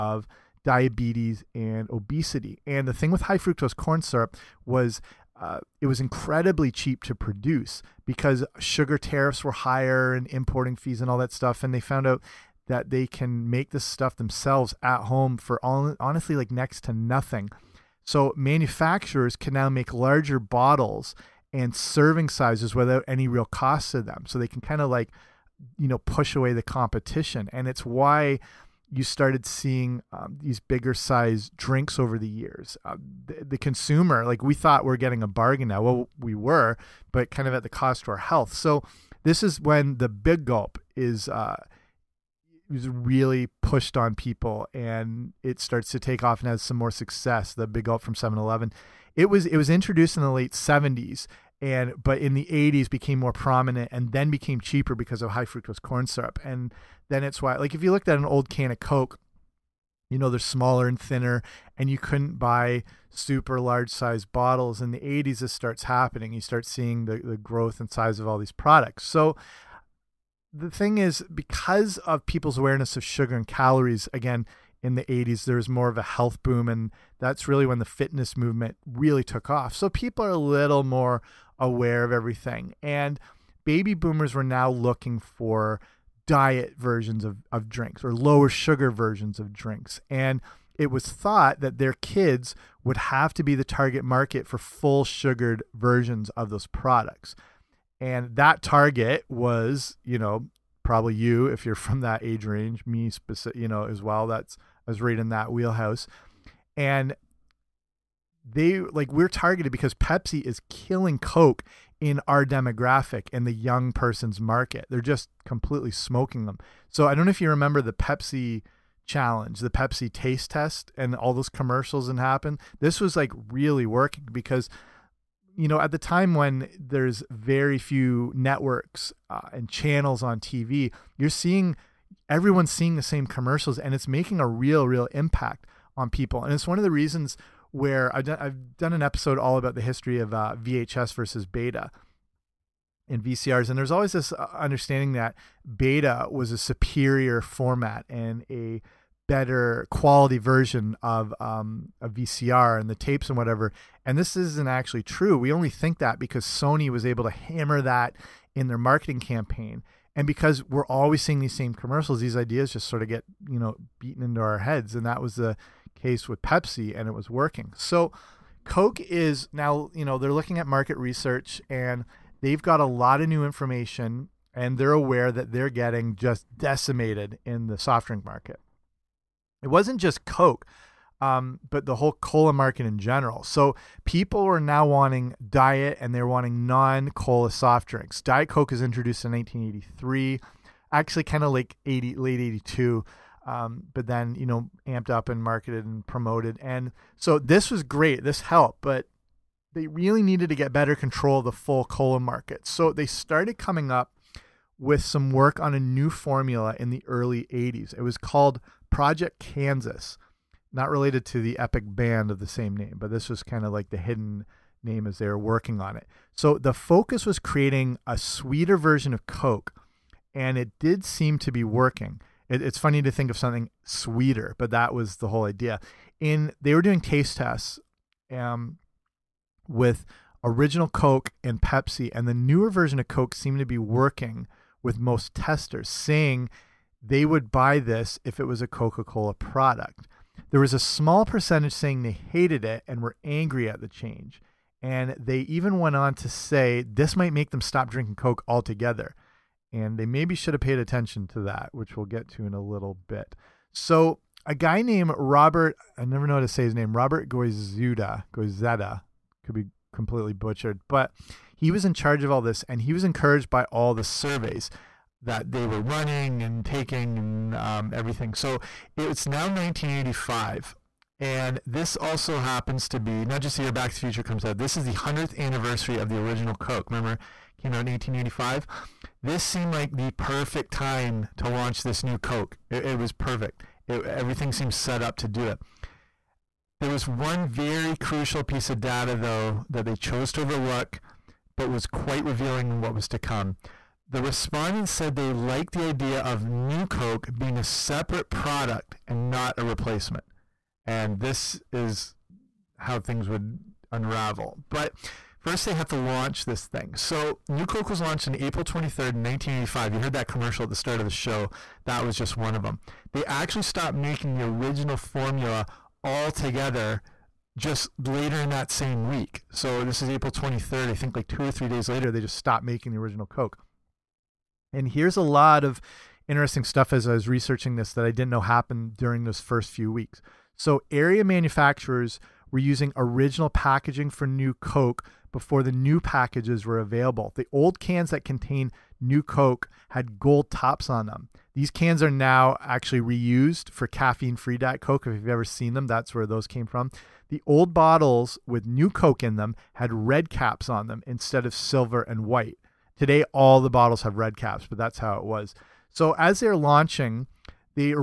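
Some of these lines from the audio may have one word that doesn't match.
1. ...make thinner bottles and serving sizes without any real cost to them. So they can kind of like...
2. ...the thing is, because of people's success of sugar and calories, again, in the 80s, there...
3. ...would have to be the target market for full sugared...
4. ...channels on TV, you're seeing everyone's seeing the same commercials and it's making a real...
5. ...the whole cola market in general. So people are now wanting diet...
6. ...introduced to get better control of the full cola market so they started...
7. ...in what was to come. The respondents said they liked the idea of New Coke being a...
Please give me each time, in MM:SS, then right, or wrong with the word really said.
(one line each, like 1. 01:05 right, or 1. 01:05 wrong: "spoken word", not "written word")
1. 00:19 wrong: "larger", not "thinner"
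2. 01:10 wrong: "awareness", not "success"
3. 01:32 right
4. 02:09 right
5. 03:01 right
6. 03:20 wrong: "needed", not "introduced"
7. 04:52 right.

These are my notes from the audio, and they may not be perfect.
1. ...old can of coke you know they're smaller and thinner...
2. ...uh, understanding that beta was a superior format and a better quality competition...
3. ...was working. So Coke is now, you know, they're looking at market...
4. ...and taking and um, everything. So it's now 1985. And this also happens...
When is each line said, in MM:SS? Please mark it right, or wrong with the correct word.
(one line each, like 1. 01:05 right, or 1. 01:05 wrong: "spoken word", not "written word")
1. 00:58 right
2. 02:24 wrong: "version", not "competition"
3. 02:47 right
4. 04:26 right.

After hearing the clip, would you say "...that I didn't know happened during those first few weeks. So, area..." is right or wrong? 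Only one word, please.
right.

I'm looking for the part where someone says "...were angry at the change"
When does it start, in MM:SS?
04:03.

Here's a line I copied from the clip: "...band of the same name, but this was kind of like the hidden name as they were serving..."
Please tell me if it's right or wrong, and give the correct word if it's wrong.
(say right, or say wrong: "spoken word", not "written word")
wrong: "working", not "serving".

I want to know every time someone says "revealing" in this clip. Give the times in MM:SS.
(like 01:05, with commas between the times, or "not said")
04:52.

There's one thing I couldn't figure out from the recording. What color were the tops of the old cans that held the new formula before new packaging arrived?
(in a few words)
Gold.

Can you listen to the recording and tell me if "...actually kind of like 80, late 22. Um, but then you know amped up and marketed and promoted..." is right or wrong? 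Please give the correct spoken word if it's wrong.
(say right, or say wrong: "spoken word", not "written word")
wrong: "82", not "22".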